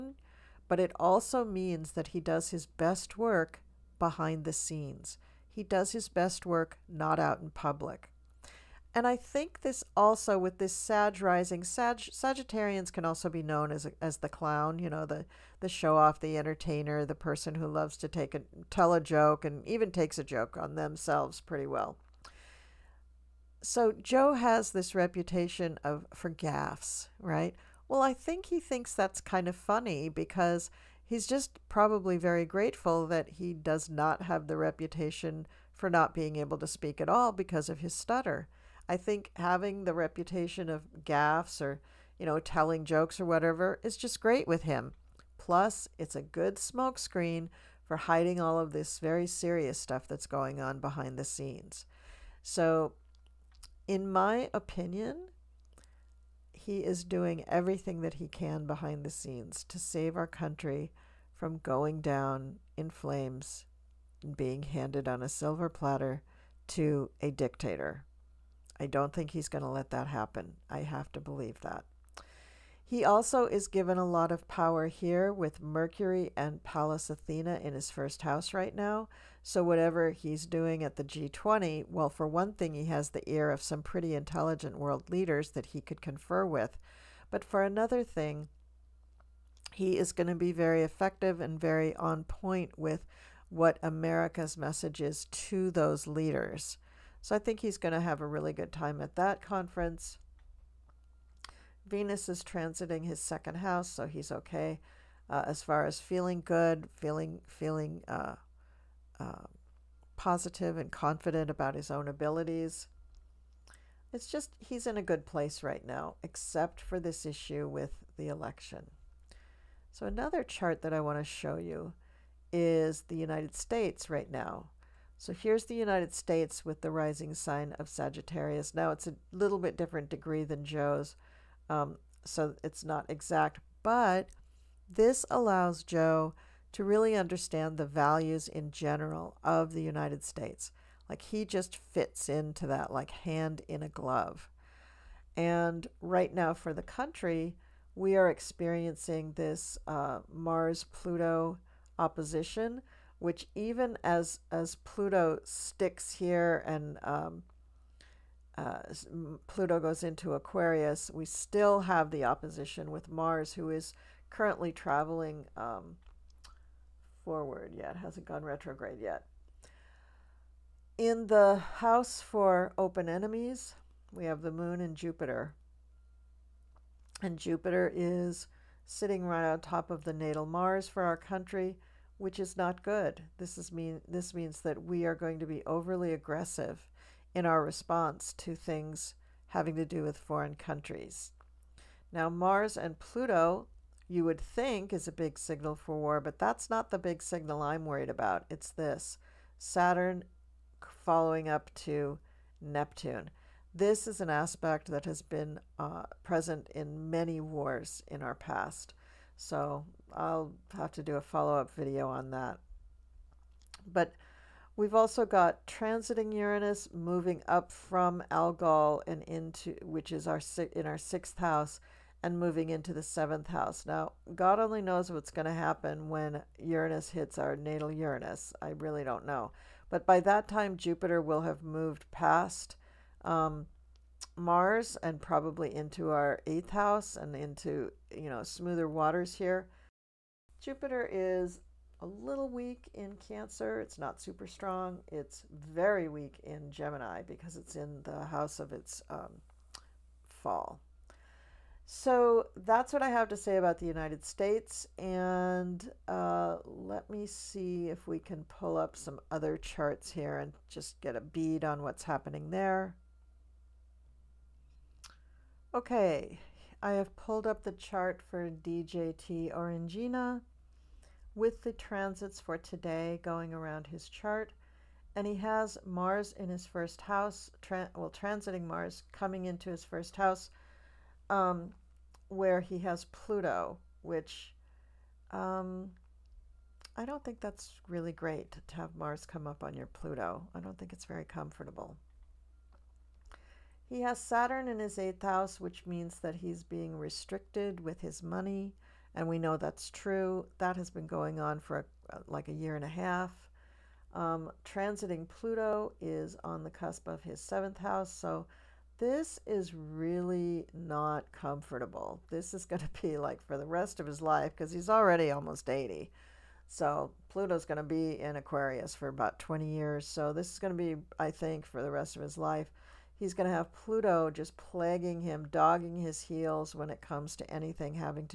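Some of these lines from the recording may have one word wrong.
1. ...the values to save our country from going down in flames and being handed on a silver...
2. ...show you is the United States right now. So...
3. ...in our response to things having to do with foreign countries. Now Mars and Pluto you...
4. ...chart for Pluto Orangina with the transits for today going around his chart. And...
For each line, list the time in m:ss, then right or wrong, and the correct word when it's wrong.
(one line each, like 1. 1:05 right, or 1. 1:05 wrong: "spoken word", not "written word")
1. 0:59 wrong: "scenes", not "values"
2. 2:01 right
3. 3:07 right
4. 4:27 wrong: "DJT", not "Pluto".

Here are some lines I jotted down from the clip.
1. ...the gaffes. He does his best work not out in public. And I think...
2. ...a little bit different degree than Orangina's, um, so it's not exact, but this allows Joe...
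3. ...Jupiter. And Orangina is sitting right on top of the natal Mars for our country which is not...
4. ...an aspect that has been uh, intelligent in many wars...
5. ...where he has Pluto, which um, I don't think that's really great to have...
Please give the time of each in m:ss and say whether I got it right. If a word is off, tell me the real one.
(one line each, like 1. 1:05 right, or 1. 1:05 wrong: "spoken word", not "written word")
1. 0:04 wrong: "scenes", not "gaffes"
2. 2:09 wrong: "Joe", not "Orangina"
3. 2:54 wrong: "Jupiter", not "Orangina"
4. 3:24 wrong: "present", not "intelligent"
5. 4:42 right.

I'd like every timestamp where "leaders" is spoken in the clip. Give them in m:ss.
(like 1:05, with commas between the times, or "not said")
1:25, 1:36.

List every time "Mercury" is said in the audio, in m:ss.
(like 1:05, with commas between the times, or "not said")
1:15.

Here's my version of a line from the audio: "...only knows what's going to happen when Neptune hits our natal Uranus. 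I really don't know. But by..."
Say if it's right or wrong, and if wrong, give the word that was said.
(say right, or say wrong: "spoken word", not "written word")
wrong: "Uranus", not "Neptune".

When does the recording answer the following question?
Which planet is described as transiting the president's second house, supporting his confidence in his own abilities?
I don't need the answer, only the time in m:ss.
1:41.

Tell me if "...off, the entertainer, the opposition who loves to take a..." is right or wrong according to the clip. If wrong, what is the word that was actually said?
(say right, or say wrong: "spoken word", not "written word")
wrong: "person", not "opposition".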